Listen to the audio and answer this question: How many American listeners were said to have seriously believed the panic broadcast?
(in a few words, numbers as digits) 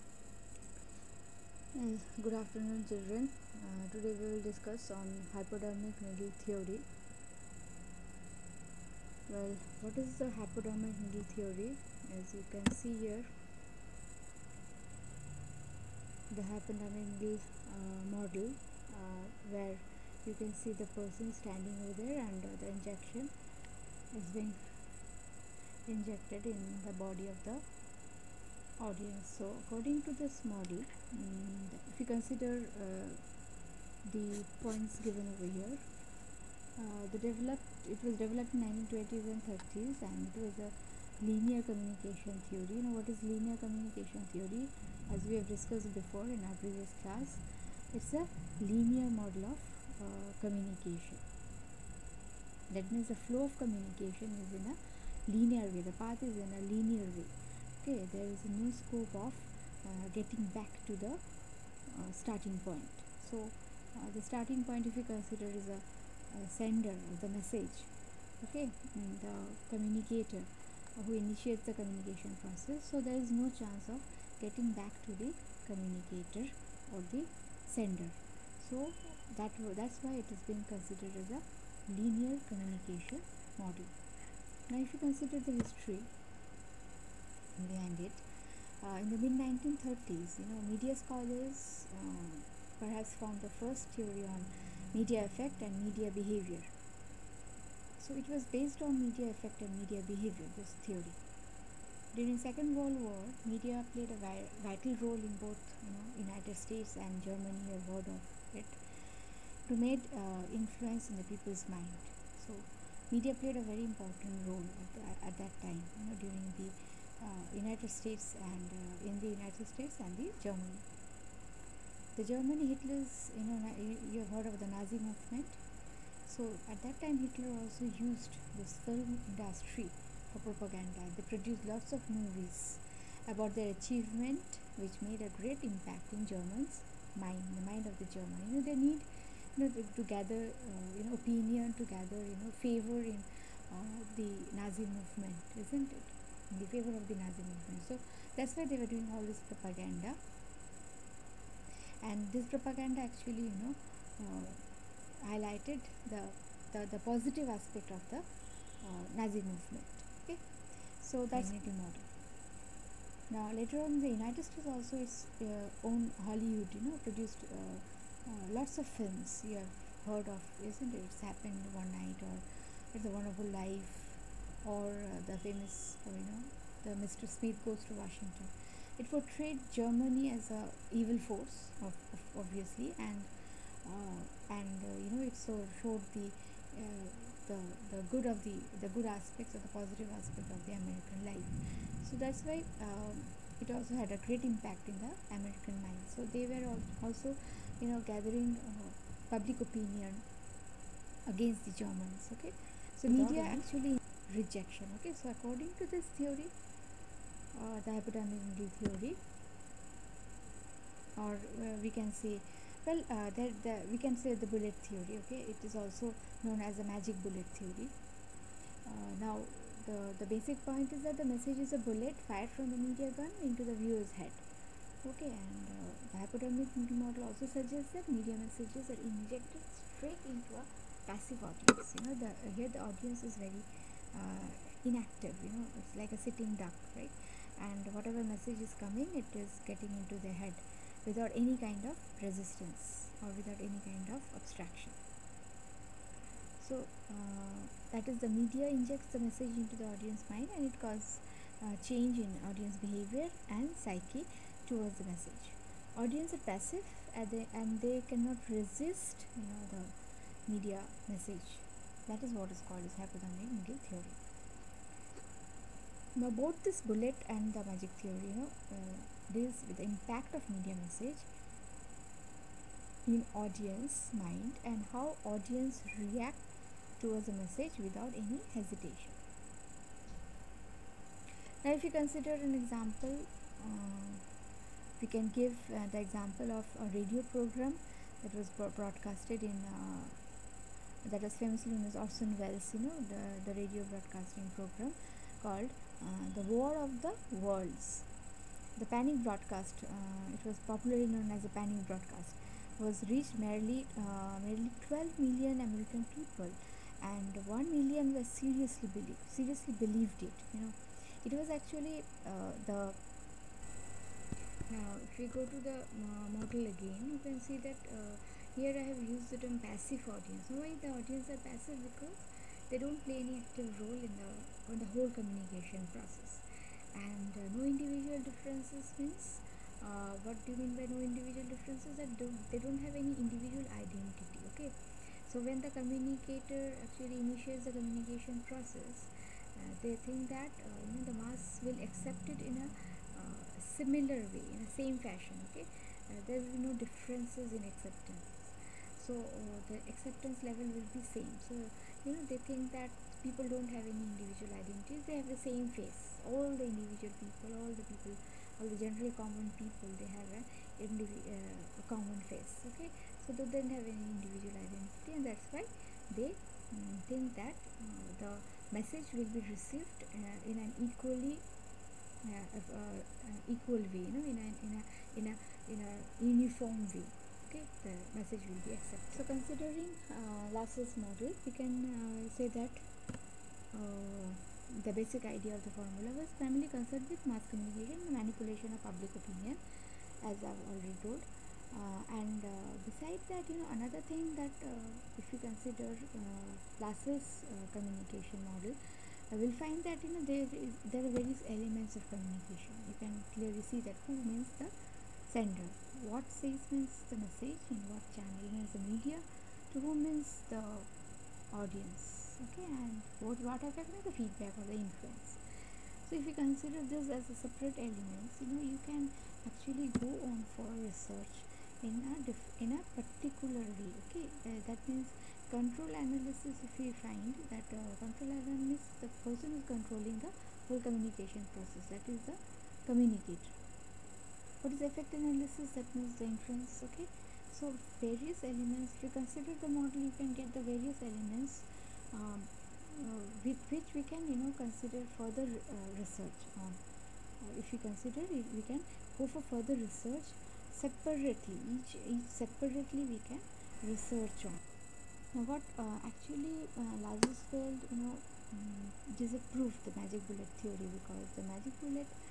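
1 million.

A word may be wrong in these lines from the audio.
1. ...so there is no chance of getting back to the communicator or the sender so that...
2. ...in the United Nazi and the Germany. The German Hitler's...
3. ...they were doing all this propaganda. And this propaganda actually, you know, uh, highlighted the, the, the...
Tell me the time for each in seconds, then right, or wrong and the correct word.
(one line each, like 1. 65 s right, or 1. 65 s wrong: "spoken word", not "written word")
1. 72 s right
2. 119 s wrong: "States", not "Nazi"
3. 148 s right.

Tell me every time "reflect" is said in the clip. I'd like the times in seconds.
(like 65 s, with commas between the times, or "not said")
not said.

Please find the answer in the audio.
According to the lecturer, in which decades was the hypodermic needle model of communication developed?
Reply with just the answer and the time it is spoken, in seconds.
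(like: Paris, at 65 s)
1920s and 30s, at 38 s.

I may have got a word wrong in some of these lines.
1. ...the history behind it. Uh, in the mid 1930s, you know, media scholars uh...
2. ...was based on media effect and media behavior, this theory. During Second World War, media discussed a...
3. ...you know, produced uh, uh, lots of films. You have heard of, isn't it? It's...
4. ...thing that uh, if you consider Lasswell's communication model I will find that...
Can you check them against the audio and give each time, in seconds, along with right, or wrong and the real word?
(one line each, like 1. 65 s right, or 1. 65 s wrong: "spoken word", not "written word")
1. 85 s right
2. 98 s wrong: "played", not "discussed"
3. 166 s right
4. 394 s right.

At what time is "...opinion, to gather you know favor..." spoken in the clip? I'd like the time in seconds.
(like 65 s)
141 s.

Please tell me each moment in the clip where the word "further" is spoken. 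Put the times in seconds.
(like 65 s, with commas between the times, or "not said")
445 s, 449 s.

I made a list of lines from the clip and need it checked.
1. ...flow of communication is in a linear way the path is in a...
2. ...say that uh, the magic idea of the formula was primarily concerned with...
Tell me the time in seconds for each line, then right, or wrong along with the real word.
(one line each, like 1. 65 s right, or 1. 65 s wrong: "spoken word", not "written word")
1. 53 s right
2. 382 s wrong: "basic", not "magic".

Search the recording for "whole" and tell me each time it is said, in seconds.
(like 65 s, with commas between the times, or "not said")
324 s, 430 s.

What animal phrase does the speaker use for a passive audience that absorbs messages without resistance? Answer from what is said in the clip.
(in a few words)
sitting duck.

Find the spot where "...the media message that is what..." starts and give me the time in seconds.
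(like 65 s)
259 s.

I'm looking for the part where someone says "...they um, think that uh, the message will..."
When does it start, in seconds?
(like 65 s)
366 s.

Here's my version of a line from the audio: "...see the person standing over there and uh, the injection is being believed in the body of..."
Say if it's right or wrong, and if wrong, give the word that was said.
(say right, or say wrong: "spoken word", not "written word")
wrong: "injected", not "believed".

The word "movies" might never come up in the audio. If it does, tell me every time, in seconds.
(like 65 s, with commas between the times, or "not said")
132 s.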